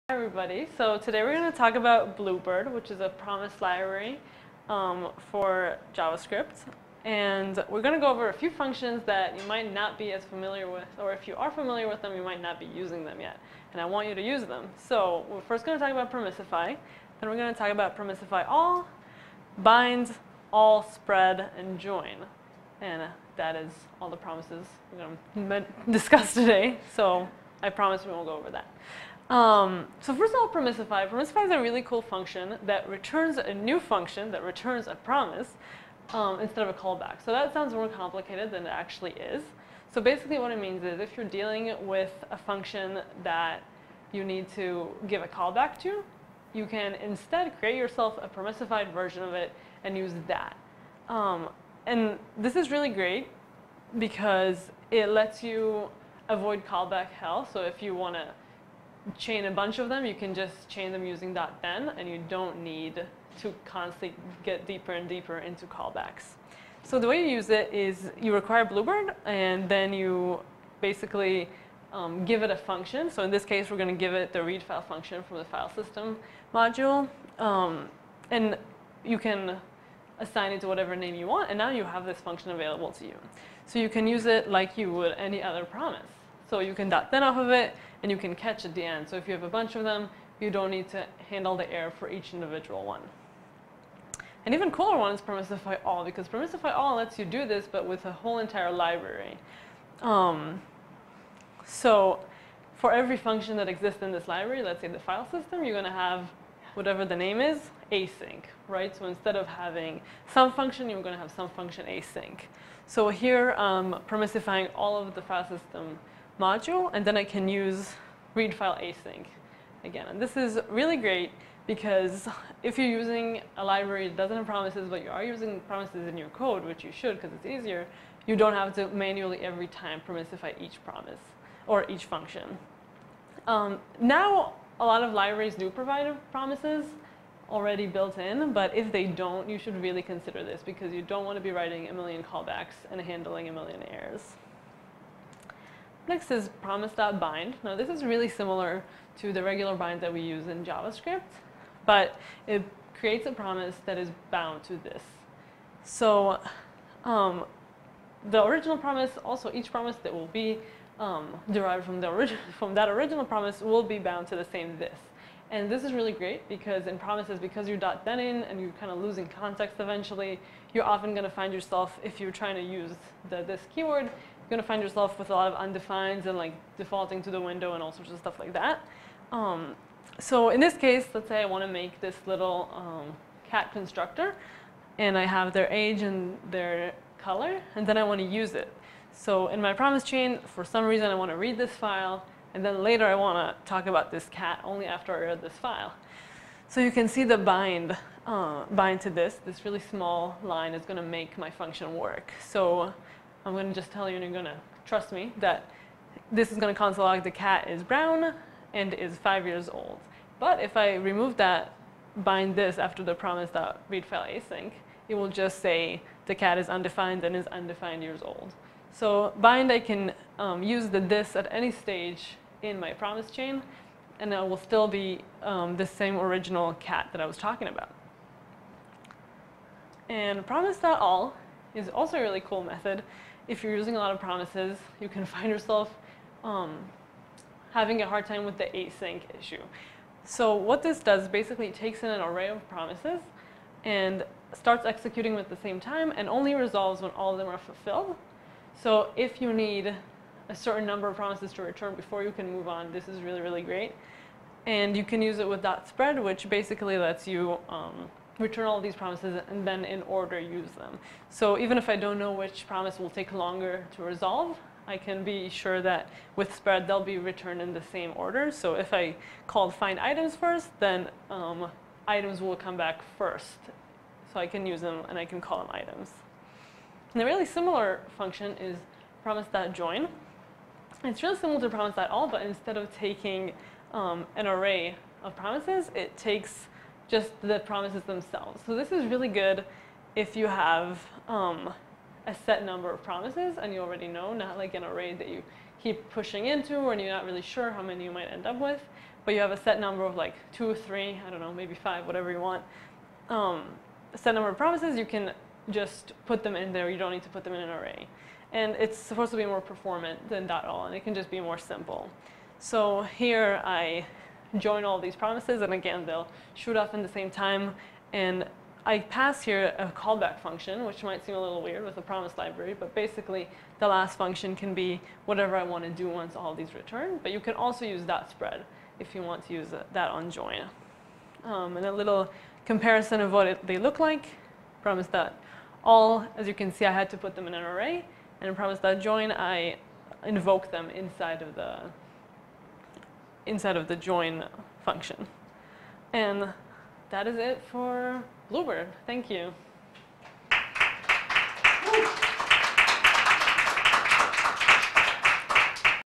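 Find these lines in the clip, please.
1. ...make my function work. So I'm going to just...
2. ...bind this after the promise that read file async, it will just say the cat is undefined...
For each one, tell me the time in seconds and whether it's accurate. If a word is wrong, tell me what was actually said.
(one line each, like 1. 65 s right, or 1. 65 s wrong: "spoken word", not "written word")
1. 201 s right
2. 212 s right.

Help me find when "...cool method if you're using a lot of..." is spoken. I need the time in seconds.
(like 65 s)
232 s.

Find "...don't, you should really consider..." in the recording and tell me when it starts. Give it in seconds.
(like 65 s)
139 s.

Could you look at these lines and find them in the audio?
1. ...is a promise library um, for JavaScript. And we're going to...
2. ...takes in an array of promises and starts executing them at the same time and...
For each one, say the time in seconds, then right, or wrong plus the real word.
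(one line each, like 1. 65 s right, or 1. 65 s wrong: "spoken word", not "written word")
1. 2 s right
2. 241 s right.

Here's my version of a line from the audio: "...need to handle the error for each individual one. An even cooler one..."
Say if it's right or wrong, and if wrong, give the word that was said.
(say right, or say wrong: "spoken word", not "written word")
right.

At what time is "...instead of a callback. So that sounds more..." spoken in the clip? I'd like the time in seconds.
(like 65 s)
36 s.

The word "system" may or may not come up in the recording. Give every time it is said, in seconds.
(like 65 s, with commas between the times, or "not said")
75 s, 105 s, 115 s.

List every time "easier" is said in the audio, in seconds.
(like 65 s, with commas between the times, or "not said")
127 s.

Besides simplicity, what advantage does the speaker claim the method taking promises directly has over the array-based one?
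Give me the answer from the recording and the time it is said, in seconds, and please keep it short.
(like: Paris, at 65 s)
more performant, at 309 s.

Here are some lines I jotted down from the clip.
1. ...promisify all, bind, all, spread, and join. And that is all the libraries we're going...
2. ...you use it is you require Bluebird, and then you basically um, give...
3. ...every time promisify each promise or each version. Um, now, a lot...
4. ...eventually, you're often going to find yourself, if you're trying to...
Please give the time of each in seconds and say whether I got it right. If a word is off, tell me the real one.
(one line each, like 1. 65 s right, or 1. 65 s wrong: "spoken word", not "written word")
1. 17 s wrong: "promises", not "libraries"
2. 67 s right
3. 129 s wrong: "function", not "version"
4. 169 s right.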